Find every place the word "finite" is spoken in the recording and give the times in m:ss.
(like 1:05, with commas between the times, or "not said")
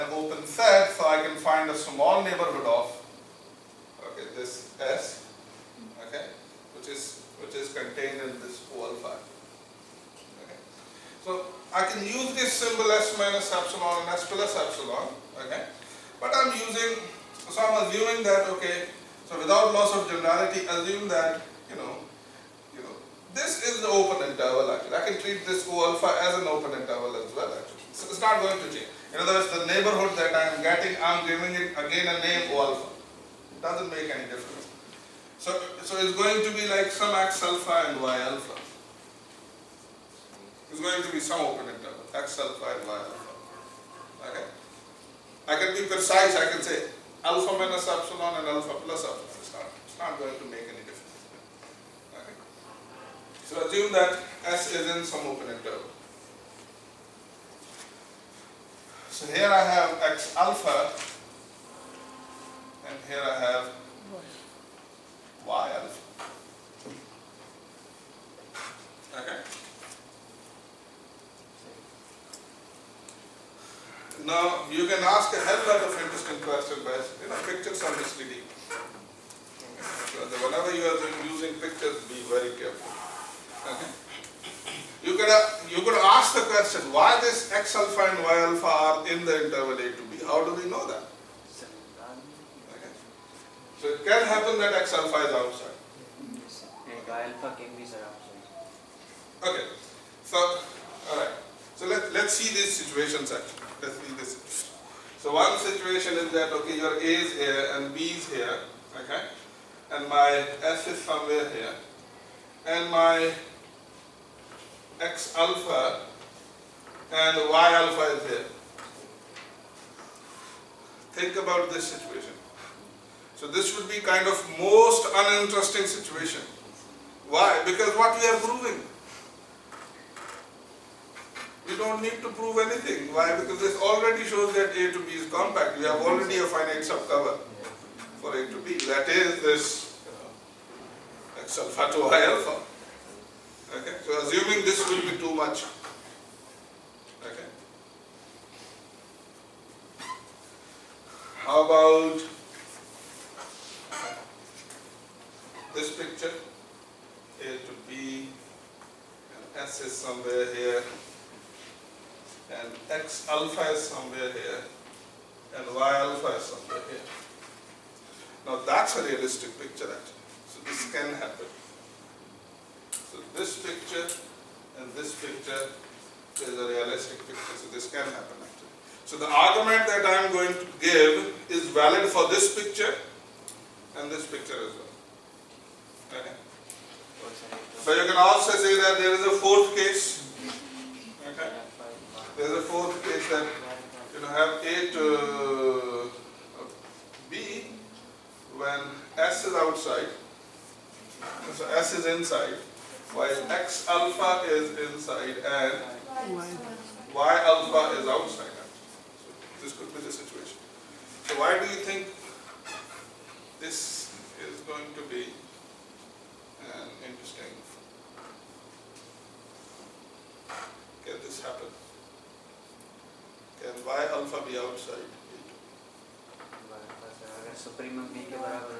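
2:16.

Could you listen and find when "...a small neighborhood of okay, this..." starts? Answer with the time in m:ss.
0:01.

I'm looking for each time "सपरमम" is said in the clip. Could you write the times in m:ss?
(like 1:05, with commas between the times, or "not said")
3:47.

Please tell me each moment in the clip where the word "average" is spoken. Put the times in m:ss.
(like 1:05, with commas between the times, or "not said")
not said.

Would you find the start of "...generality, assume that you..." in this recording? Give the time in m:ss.
0:20.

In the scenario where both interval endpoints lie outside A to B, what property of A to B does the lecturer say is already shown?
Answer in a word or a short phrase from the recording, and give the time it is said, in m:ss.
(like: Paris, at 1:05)
Compact, at 2:15.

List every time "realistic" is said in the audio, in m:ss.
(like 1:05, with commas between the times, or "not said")
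2:49, 2:56.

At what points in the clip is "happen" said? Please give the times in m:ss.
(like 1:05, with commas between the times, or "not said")
1:34, 2:51, 2:58, 3:41.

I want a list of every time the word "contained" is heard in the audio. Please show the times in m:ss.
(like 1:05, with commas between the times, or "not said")
0:07.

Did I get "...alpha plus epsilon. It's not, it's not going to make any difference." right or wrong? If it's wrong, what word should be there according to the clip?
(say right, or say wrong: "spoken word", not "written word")
right.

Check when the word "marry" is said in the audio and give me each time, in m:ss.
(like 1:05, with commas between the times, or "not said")
not said.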